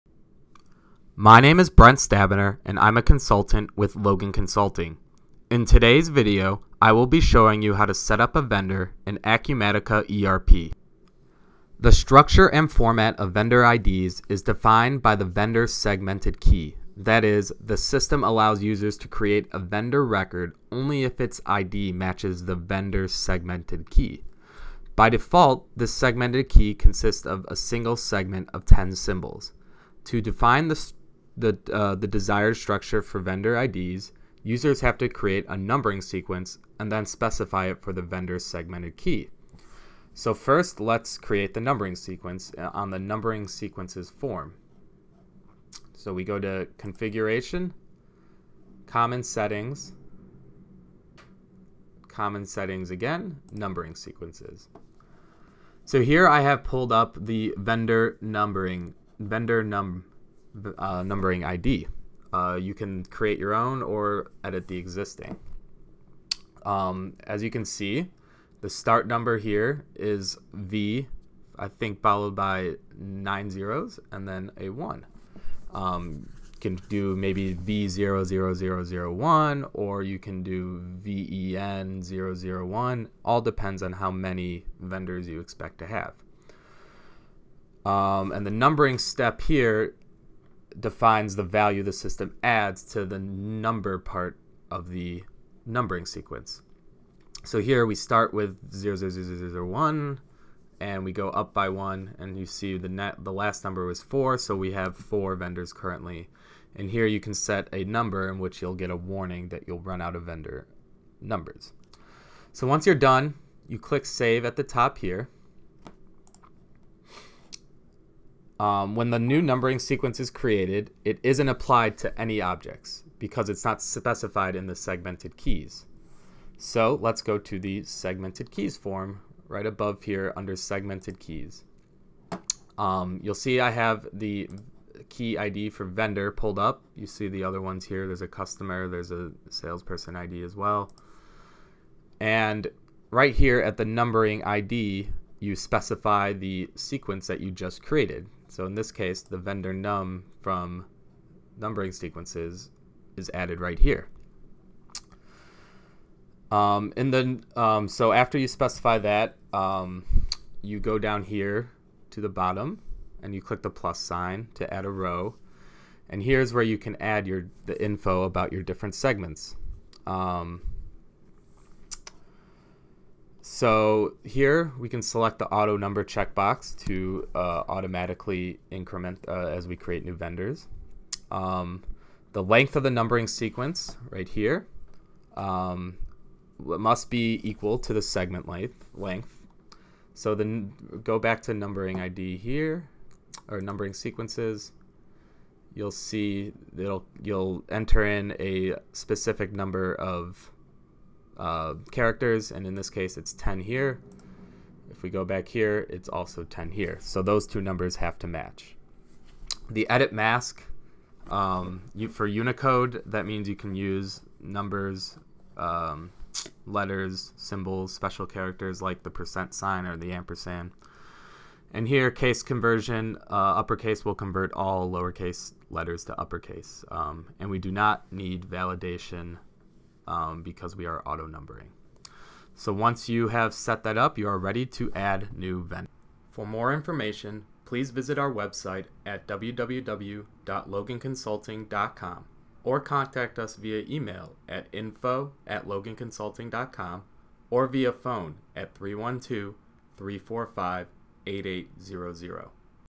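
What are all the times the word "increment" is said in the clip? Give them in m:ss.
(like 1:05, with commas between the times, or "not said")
2:58.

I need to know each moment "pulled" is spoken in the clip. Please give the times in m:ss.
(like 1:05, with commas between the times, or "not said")
0:56, 2:16.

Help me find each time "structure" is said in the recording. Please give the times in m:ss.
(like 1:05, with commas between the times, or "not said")
0:11, 0:32.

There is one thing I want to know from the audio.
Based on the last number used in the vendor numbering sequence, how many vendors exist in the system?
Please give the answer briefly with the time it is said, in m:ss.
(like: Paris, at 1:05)
4, at 1:44.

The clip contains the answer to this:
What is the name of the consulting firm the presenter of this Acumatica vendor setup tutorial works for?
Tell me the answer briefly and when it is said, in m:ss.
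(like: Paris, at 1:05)
Logan Consulting, at 0:03.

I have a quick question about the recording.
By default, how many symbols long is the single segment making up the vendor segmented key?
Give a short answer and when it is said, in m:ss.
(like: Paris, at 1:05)
10, at 0:28.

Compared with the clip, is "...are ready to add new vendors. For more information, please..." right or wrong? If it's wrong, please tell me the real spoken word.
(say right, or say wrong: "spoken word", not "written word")
right.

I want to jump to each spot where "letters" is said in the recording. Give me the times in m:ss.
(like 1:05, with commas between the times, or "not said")
3:36, 3:45.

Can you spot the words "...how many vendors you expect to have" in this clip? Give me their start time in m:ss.
1:23.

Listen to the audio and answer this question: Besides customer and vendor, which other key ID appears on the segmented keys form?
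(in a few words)
salesperson ID.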